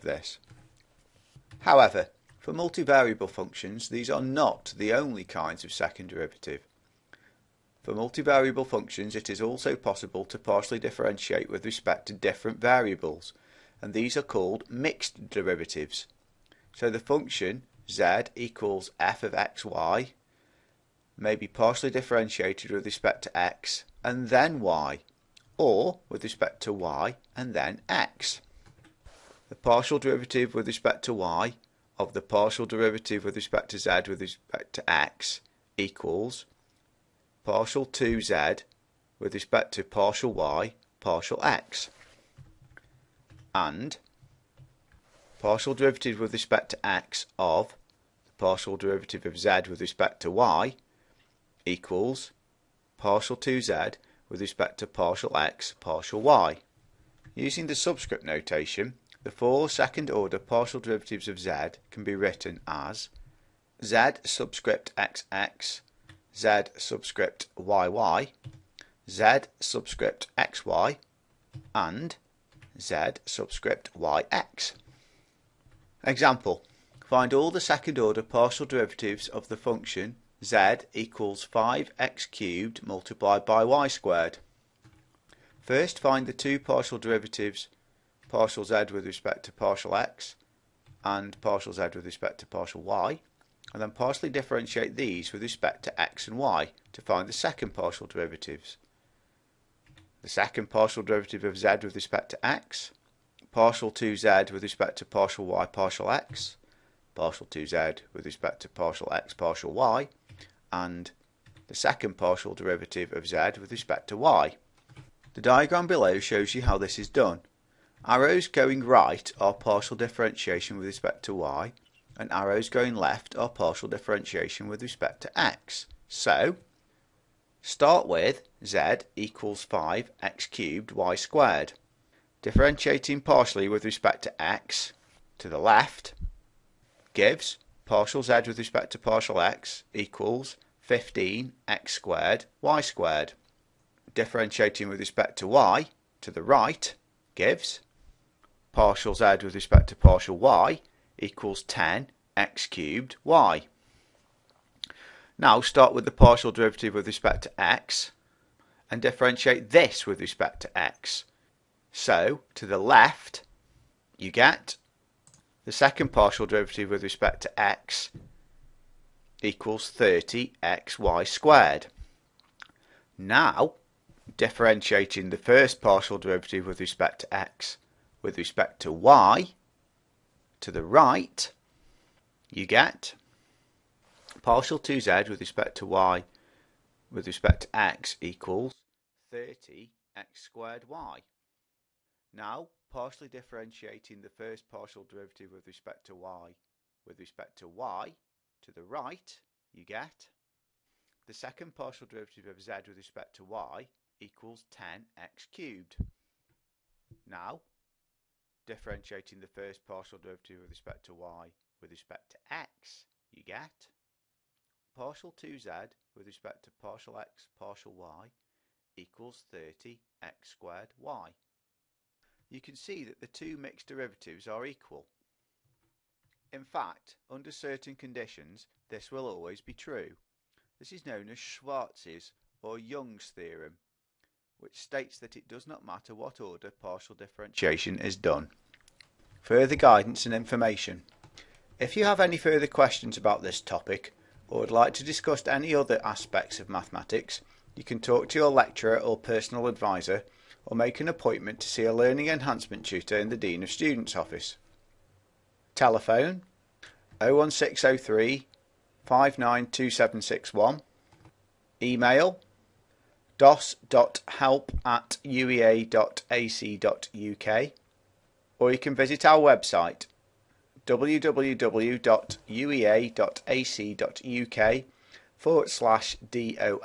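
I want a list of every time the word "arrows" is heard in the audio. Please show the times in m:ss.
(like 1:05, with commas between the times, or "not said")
1:58, 2:02.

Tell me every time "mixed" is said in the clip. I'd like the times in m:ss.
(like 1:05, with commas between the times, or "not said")
0:14, 3:43.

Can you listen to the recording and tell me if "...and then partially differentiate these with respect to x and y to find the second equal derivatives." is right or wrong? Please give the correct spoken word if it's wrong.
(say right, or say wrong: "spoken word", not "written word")
wrong: "partial", not "equal".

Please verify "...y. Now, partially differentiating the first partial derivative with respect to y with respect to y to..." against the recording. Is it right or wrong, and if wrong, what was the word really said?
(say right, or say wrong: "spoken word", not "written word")
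right.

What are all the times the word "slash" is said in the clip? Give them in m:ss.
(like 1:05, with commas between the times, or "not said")
4:35.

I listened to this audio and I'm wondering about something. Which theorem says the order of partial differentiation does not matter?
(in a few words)
Schwarz's or Young's theorem.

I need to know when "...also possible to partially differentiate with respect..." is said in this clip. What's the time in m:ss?
0:09.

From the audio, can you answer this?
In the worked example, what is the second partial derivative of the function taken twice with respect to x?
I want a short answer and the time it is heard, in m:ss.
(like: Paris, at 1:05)
30xy², at 2:49.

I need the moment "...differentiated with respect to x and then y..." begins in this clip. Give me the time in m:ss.
0:21.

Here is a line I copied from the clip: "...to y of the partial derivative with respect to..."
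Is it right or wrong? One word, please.
right.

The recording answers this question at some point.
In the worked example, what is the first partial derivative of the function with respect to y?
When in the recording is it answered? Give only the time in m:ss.
2:31.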